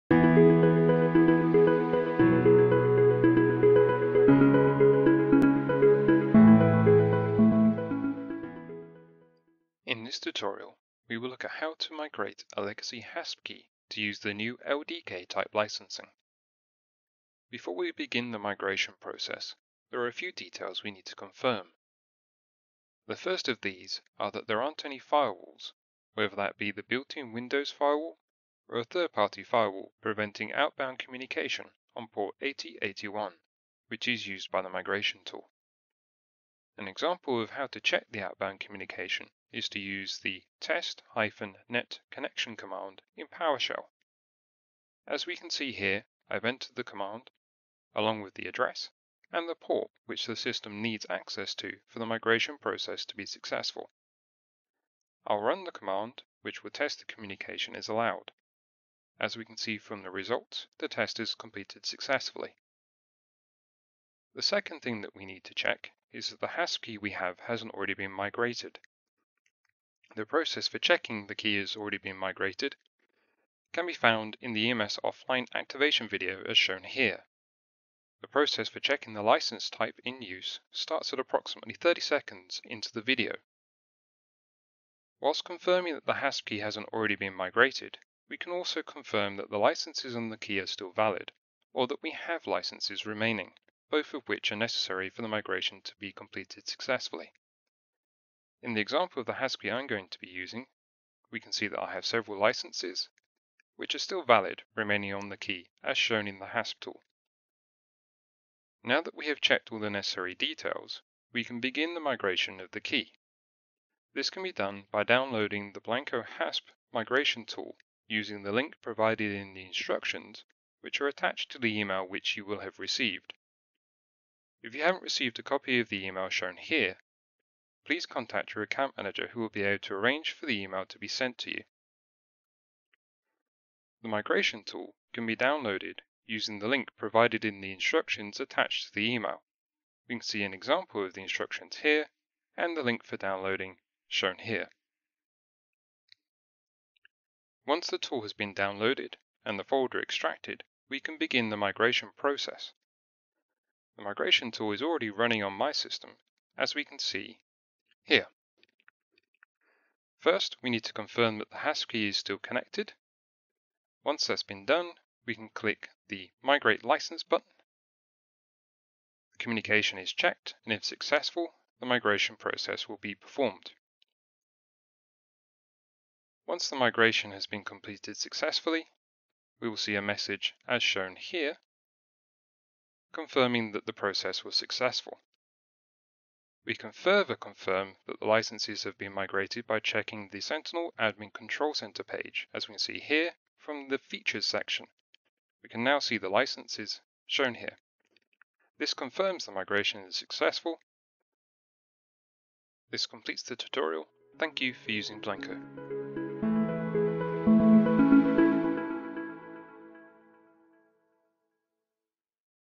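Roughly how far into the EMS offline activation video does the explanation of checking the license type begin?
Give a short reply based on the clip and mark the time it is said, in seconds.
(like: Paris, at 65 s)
30 seconds, at 81 s.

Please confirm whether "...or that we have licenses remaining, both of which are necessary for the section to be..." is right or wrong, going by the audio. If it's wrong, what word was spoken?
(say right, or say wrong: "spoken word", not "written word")
wrong: "migration", not "section".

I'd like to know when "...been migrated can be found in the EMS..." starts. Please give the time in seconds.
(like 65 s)
71 s.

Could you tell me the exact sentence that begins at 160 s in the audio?
First, we need to confirm that the HASP key is still connected.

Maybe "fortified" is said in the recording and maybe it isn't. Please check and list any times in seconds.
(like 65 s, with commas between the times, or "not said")
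not said.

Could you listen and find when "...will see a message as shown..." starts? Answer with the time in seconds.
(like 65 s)
179 s.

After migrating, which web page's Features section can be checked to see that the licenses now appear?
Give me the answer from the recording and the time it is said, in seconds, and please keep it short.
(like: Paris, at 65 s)
Sentinel Admin Control Center, at 190 s.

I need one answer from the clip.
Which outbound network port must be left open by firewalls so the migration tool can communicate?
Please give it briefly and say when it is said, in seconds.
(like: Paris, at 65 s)
8081, at 32 s.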